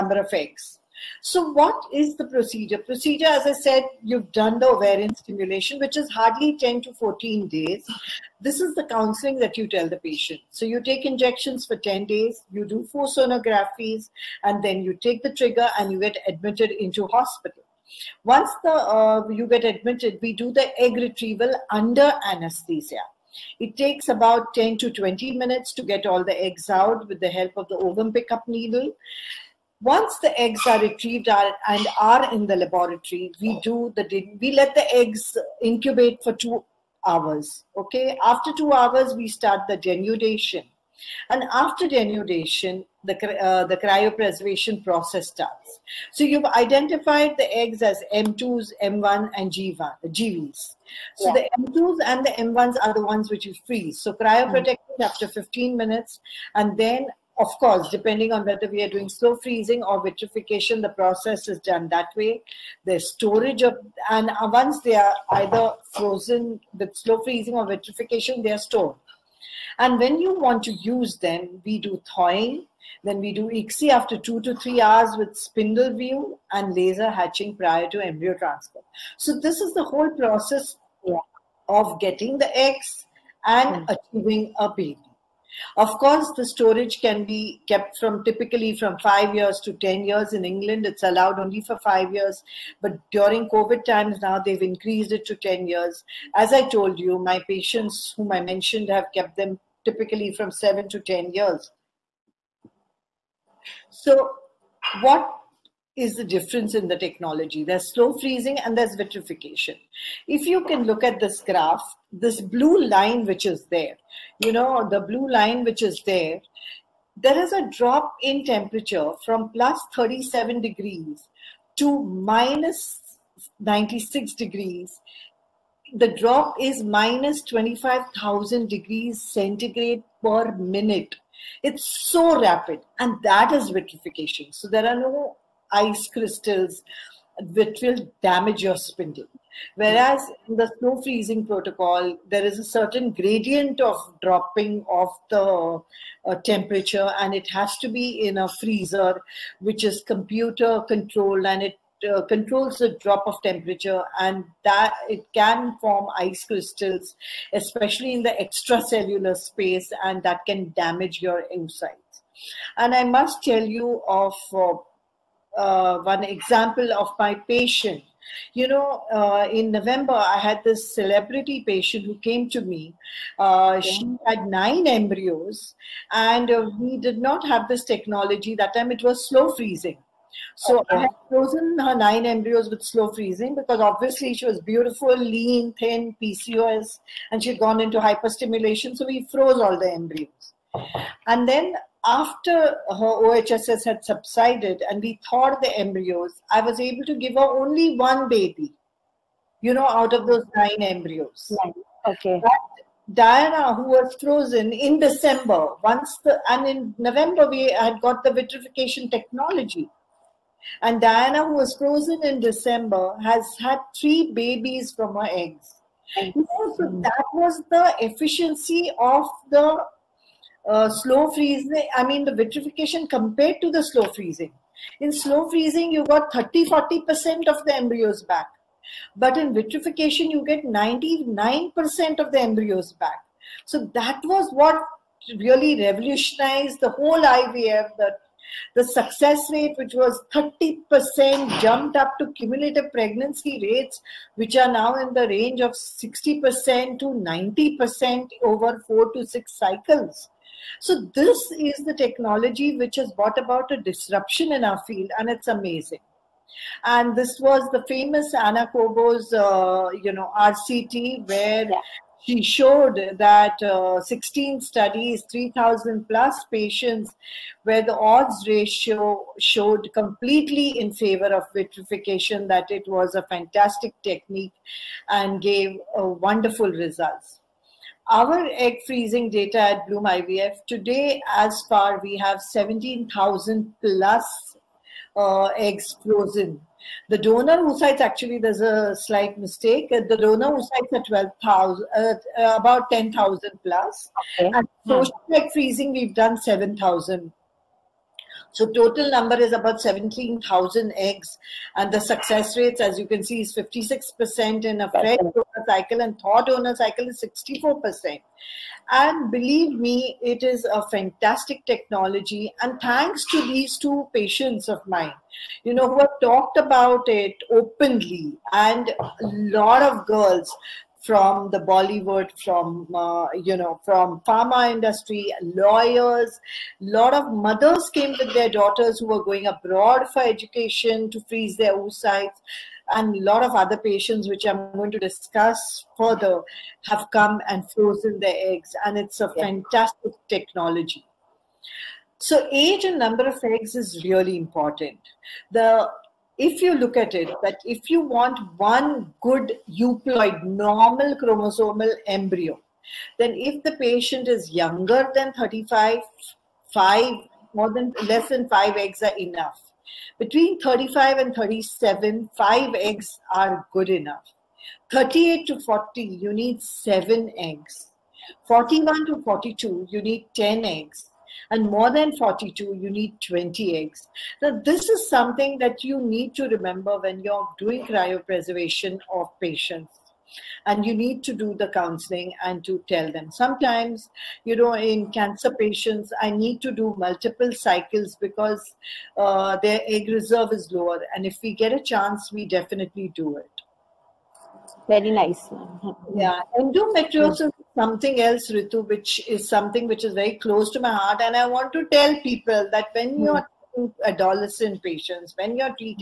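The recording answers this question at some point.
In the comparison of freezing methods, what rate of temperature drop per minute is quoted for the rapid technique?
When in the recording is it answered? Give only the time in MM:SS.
02:06.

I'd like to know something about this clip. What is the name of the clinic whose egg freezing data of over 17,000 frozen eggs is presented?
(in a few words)
Bloom IVF.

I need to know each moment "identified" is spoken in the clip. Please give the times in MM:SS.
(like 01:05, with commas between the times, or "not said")
00:46.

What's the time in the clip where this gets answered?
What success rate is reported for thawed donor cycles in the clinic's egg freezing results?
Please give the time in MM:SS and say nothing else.
05:07.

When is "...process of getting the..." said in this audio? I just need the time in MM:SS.
01:20.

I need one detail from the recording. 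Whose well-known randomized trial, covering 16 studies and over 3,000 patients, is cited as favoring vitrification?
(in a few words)
Ana Cobo.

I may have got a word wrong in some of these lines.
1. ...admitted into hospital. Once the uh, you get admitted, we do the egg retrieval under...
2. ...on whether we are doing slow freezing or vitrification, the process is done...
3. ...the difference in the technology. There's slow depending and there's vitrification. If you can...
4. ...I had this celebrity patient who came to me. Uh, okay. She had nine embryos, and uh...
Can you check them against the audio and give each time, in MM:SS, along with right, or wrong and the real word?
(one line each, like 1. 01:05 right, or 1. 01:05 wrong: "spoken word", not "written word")
1. 00:16 right
2. 00:58 right
3. 01:46 wrong: "freezing", not "depending"
4. 02:50 right.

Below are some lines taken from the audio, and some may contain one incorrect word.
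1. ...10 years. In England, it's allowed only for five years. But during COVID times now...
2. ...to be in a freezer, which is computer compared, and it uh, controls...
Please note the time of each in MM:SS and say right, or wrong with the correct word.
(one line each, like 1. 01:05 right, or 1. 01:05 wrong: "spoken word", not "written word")
1. 01:29 right
2. 02:27 wrong: "controlled", not "compared".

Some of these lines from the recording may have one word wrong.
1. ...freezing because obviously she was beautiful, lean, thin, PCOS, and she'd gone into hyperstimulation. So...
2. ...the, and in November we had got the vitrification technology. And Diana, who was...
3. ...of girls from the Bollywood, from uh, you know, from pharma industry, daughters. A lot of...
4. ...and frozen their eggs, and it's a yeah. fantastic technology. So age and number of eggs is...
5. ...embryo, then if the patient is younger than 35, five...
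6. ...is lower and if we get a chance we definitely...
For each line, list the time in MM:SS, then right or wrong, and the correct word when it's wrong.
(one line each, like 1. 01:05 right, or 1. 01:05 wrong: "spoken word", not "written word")
1. 03:03 right
2. 03:26 right
3. 05:19 wrong: "lawyers", not "daughters"
4. 05:37 right
5. 05:52 right
6. 06:30 right.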